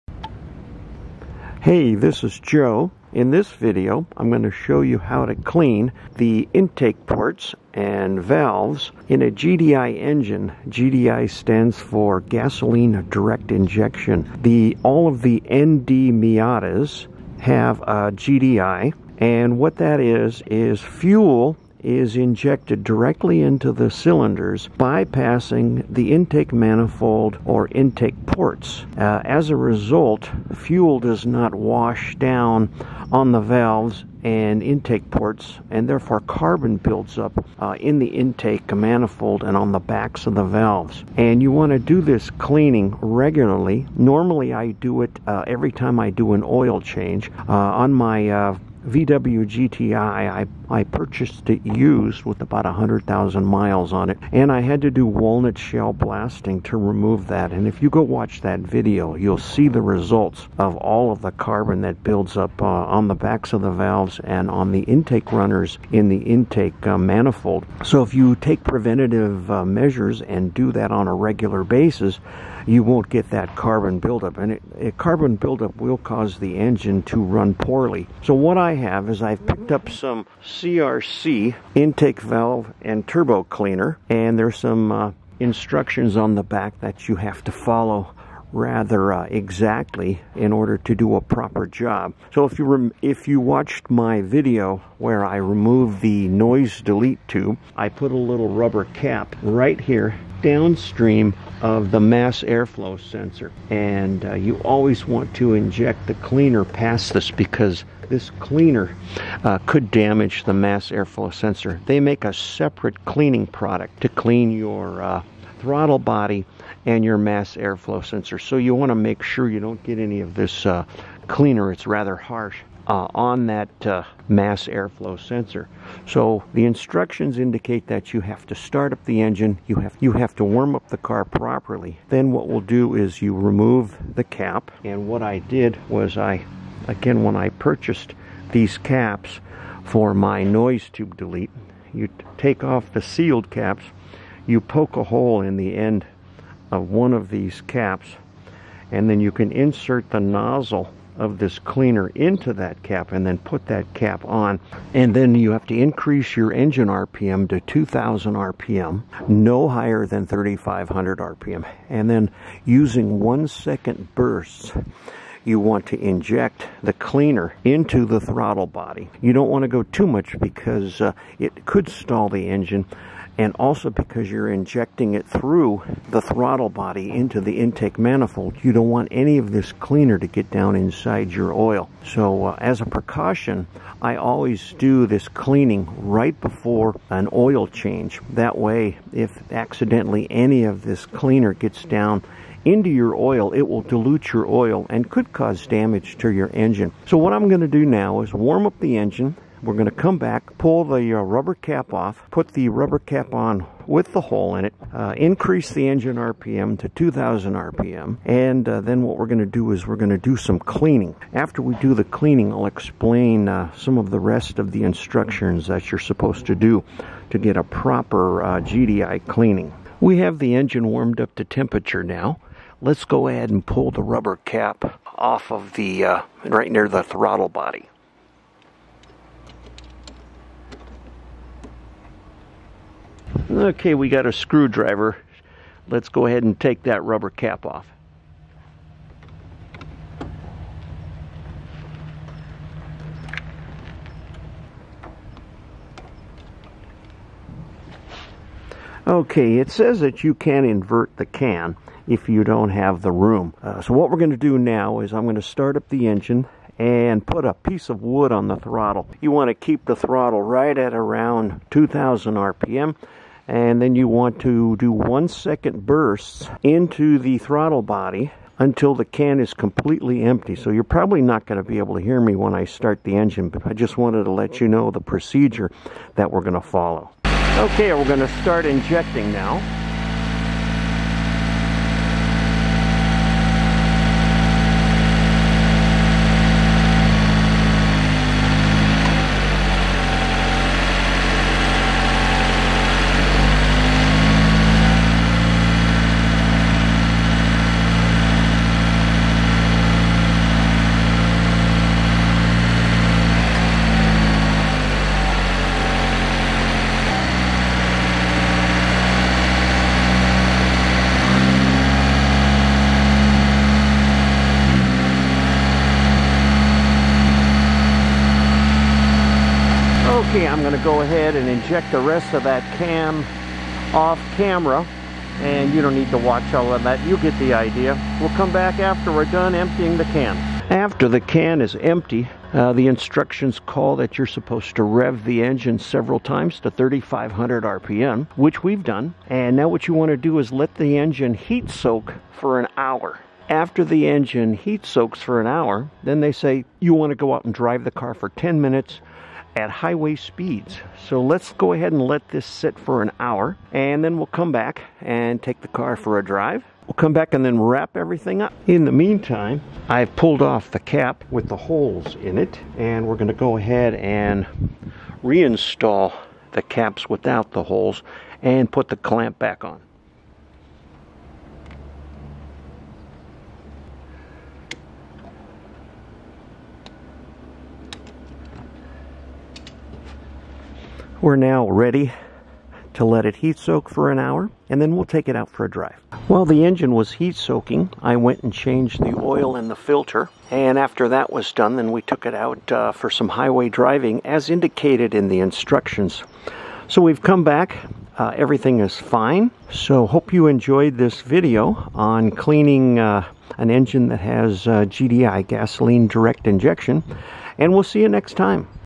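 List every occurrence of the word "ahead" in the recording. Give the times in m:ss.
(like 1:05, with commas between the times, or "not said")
3:43, 3:56, 5:21, 5:51, 6:03.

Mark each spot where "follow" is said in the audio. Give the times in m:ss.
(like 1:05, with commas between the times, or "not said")
1:27, 4:36.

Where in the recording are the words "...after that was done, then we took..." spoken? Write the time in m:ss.
6:30.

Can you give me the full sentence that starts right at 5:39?
And now what you want to do is let the engine heat soak for an hour.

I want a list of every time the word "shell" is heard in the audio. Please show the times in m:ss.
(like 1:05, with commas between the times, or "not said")
0:55.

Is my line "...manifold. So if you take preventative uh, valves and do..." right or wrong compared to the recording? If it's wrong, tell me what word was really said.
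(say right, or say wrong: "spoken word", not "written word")
wrong: "measures", not "valves".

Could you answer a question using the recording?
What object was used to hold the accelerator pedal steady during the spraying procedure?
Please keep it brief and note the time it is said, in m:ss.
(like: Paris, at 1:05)
A piece of wood, at 4:17.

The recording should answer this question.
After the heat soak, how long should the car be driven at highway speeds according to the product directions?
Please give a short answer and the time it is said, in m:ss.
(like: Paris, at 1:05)
10 minutes, at 5:48.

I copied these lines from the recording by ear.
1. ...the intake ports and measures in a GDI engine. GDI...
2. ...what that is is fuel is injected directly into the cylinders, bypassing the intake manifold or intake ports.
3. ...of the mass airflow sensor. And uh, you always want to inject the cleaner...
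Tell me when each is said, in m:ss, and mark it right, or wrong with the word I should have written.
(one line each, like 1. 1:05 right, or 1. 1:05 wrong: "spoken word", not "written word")
1. 0:06 wrong: "valves", not "measures"
2. 0:19 right
3. 1:41 right.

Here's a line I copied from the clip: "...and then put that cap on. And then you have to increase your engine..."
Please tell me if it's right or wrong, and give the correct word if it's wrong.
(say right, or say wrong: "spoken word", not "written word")
right.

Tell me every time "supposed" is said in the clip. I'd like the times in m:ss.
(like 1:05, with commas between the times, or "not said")
3:35, 5:34.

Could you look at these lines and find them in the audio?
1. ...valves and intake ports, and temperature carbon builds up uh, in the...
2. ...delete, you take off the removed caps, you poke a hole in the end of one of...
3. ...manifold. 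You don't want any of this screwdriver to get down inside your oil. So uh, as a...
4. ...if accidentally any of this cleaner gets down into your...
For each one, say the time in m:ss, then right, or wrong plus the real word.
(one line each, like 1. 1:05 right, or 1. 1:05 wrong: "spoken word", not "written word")
1. 0:33 wrong: "therefore", not "temperature"
2. 2:21 wrong: "sealed", not "removed"
3. 2:57 wrong: "cleaner", not "screwdriver"
4. 3:09 right.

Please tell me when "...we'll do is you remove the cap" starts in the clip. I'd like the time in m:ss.
2:12.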